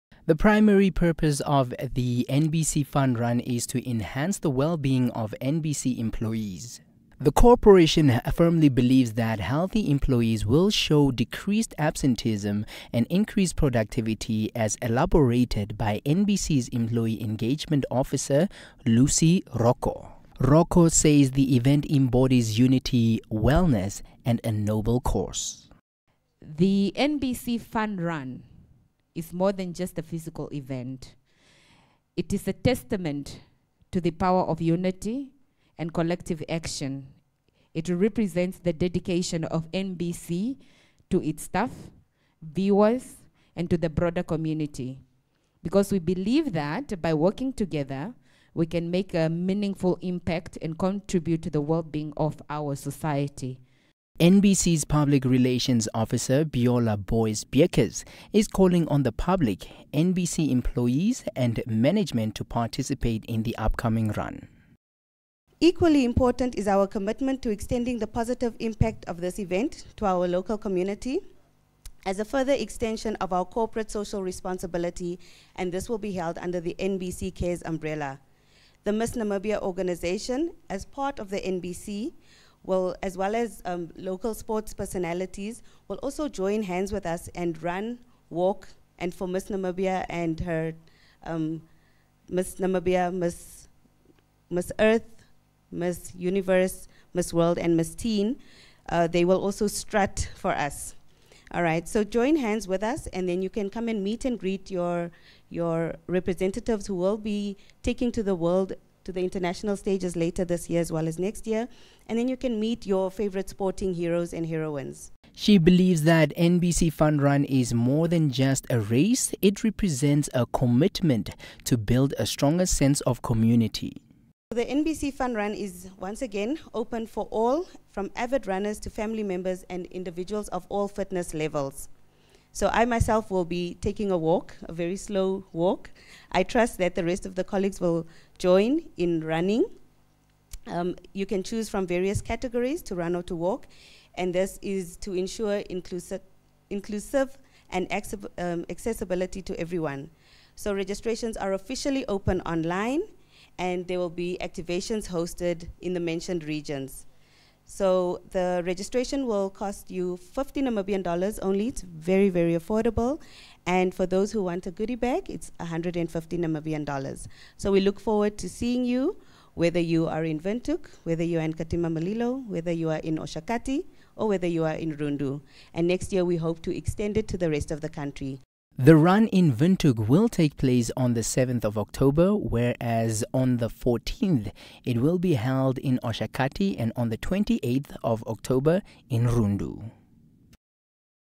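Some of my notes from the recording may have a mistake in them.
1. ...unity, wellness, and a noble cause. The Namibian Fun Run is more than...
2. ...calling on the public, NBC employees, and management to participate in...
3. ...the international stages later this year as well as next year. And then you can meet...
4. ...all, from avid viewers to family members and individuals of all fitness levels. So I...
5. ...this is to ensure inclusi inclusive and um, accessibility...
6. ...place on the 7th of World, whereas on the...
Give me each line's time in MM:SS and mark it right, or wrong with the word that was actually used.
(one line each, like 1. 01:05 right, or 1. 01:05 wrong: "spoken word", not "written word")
1. 00:22 wrong: "NBC", not "Namibian"
2. 00:58 right
3. 01:49 right
4. 02:07 wrong: "runners", not "viewers"
5. 02:24 right
6. 03:00 wrong: "October", not "World".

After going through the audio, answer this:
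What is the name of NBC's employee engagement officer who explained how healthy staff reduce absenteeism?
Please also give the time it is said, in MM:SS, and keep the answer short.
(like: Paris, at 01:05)
Lucy Rocco, at 00:18.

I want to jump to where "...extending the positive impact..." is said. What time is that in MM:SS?
01:07.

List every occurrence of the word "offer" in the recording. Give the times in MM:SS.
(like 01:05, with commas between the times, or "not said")
not said.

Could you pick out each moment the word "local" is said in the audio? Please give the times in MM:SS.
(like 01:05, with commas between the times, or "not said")
01:10, 01:23.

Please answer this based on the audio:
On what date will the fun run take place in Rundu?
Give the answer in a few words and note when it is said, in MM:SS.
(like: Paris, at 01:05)
28 October, at 03:07.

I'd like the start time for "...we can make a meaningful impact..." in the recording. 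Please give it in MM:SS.
00:48.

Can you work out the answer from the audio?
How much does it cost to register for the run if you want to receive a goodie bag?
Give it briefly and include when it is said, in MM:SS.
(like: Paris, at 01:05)
150 Namibian dollars, at 02:45.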